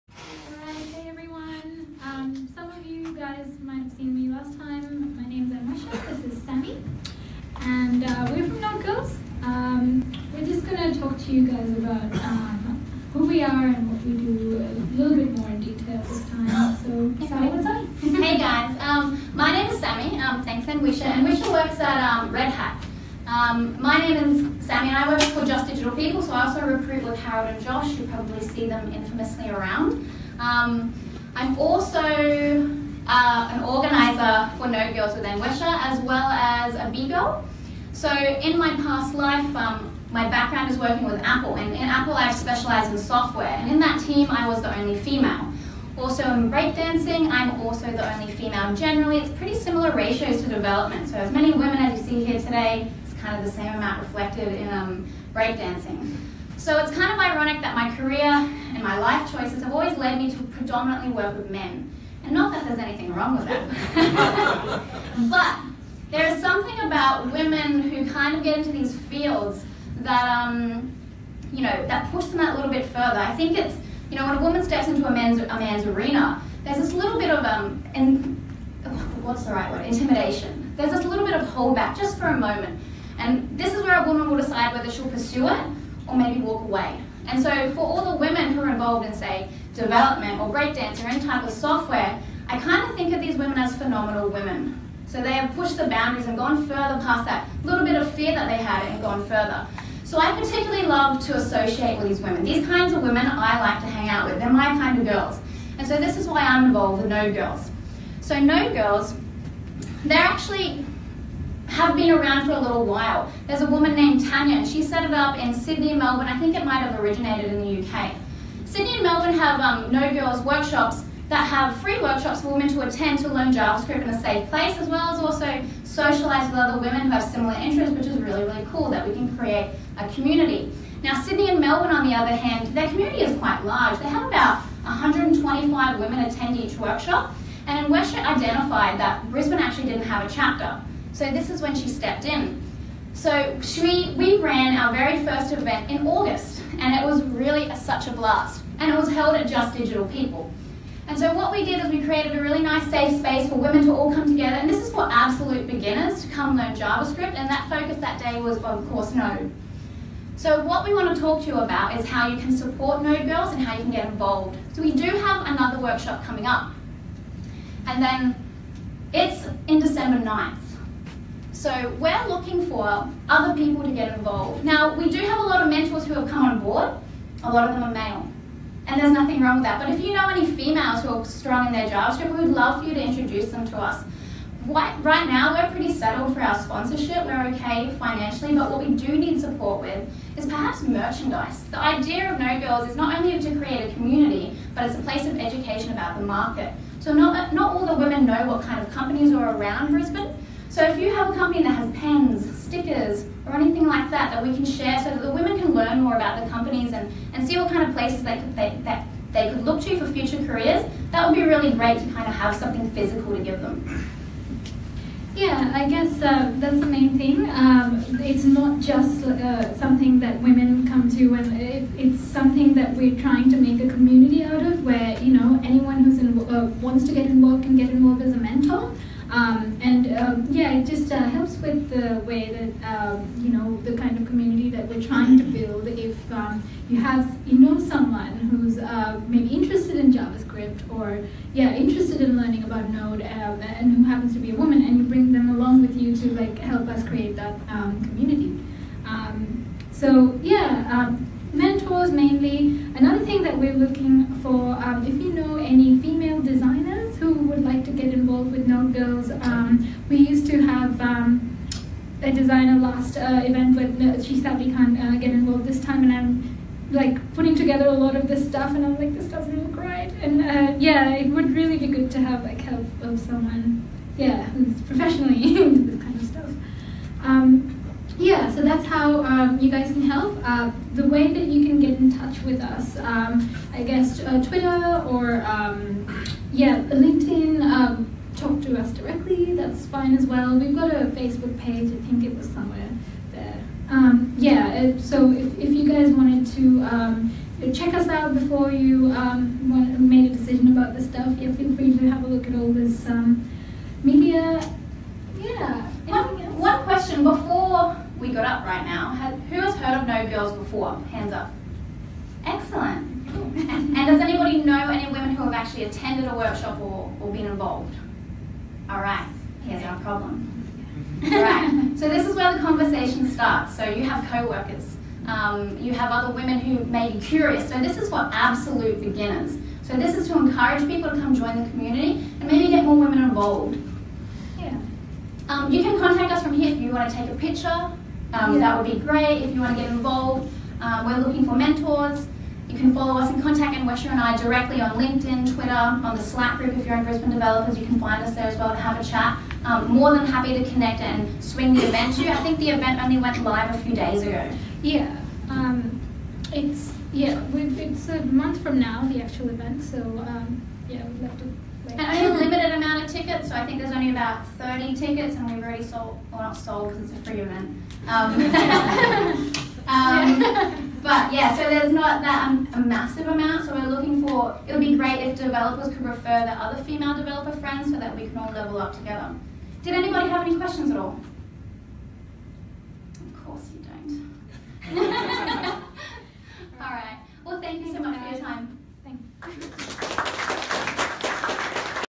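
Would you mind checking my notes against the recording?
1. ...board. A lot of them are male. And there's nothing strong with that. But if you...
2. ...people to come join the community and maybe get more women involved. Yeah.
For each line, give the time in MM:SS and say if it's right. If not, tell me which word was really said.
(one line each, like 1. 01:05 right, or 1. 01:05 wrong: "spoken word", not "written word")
1. 02:56 wrong: "wrong", not "strong"
2. 05:30 right.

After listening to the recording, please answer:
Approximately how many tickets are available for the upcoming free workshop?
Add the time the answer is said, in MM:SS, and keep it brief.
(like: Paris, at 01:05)
30, at 06:04.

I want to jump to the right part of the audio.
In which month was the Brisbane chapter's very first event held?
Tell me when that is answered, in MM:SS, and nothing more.
02:26.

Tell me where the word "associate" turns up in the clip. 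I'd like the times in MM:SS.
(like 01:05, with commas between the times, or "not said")
01:41.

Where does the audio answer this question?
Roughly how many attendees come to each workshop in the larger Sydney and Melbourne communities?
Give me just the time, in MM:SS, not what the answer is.
02:14.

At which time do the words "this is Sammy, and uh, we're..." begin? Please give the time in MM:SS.
00:06.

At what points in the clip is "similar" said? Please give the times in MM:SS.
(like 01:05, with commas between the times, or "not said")
00:49, 02:07.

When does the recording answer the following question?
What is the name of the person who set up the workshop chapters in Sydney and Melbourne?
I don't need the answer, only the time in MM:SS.
01:54.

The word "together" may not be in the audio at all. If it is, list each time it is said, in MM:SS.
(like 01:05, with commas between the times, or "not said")
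02:34, 04:27, 06:18.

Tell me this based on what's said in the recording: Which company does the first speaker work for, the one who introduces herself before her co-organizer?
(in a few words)
Red Hat.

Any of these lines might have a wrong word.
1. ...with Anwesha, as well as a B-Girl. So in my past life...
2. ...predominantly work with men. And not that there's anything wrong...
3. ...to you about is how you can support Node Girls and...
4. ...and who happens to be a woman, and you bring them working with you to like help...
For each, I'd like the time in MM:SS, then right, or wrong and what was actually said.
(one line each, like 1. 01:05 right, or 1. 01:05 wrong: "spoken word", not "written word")
1. 00:35 right
2. 01:00 right
3. 02:41 right
4. 04:03 wrong: "along", not "working".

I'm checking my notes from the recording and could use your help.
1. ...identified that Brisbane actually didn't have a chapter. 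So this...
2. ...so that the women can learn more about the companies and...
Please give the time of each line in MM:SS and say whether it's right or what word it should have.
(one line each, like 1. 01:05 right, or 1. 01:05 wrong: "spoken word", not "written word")
1. 02:18 right
2. 03:24 right.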